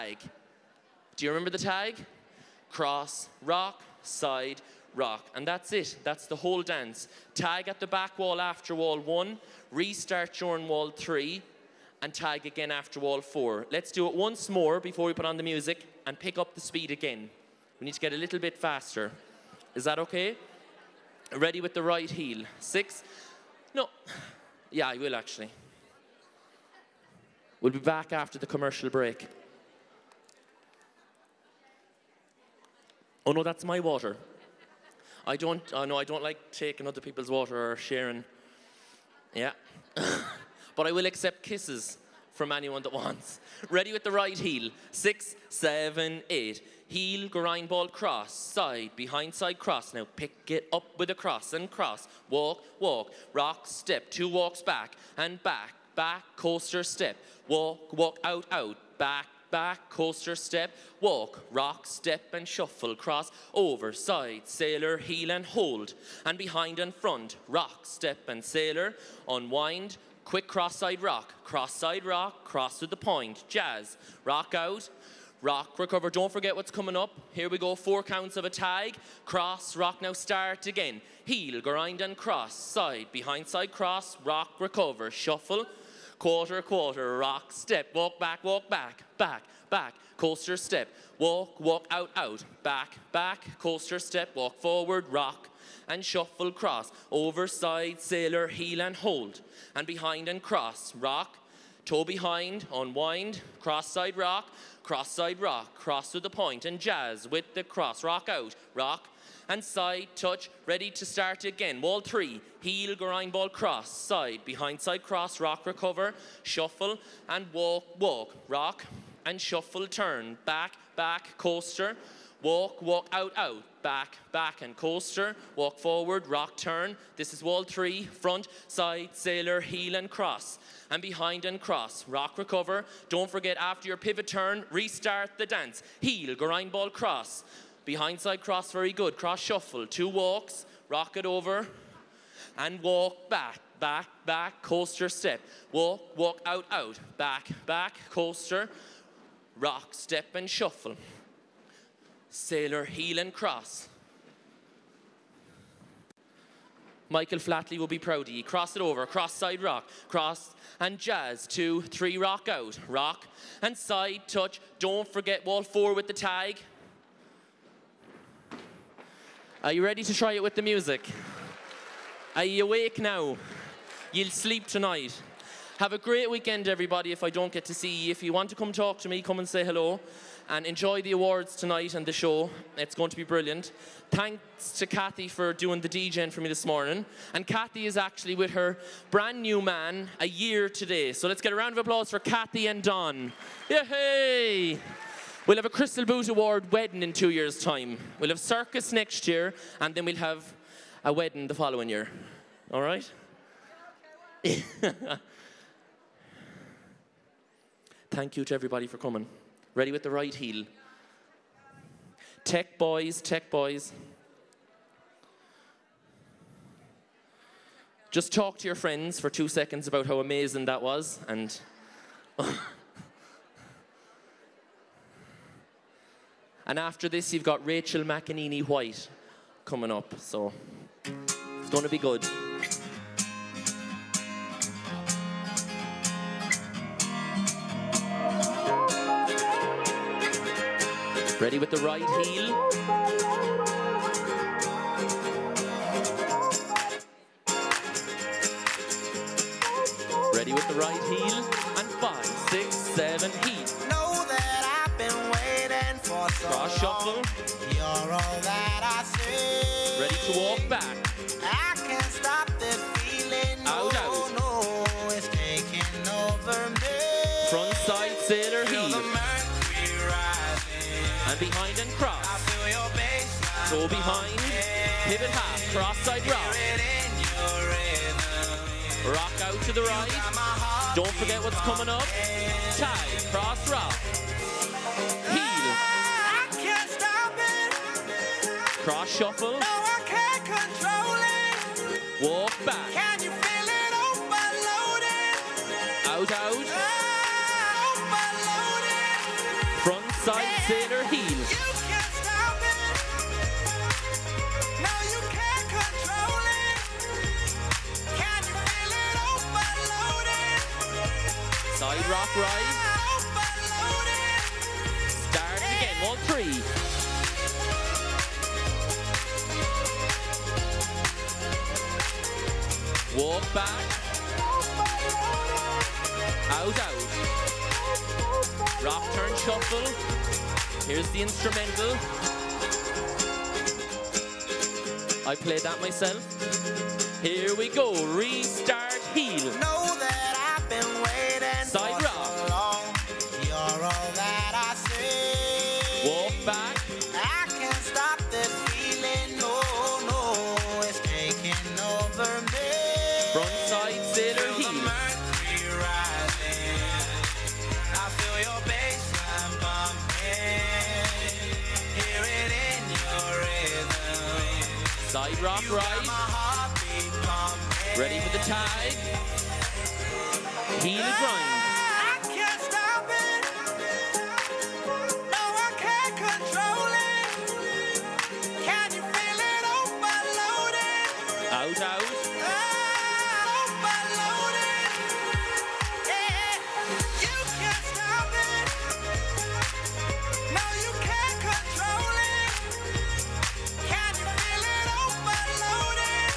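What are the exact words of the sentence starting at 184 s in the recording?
Thanks to Kathy for doing the DJing for me this morning.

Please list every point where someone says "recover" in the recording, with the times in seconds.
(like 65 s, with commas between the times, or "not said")
75 s, 84 s, 115 s, 132 s.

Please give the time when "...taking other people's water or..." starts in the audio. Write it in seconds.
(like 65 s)
36 s.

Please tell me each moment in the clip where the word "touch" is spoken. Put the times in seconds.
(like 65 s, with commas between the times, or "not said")
110 s, 164 s.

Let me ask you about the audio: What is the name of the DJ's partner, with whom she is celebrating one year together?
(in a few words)
Don.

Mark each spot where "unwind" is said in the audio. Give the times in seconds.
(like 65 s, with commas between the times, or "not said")
69 s, 102 s.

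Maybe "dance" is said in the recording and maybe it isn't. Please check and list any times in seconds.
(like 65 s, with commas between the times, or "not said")
6 s, 135 s.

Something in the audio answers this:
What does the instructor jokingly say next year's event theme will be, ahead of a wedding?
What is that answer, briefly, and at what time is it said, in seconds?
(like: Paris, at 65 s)
circus, at 198 s.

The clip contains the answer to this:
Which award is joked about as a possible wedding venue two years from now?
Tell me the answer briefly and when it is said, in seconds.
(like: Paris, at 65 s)
Crystal Boot Award, at 195 s.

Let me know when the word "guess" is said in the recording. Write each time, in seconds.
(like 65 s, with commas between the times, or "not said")
not said.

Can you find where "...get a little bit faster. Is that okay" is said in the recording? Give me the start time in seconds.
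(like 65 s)
17 s.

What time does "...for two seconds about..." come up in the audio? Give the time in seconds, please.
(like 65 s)
219 s.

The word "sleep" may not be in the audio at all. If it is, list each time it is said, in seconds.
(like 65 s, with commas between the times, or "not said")
174 s.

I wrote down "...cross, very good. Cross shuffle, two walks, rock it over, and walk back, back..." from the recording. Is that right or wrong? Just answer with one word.
right.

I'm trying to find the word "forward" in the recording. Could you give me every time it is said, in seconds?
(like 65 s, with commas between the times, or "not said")
94 s, 125 s.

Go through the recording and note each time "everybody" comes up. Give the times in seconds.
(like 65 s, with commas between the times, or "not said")
176 s, 208 s.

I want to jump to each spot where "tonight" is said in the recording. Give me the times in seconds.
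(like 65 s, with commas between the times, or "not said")
174 s, 181 s.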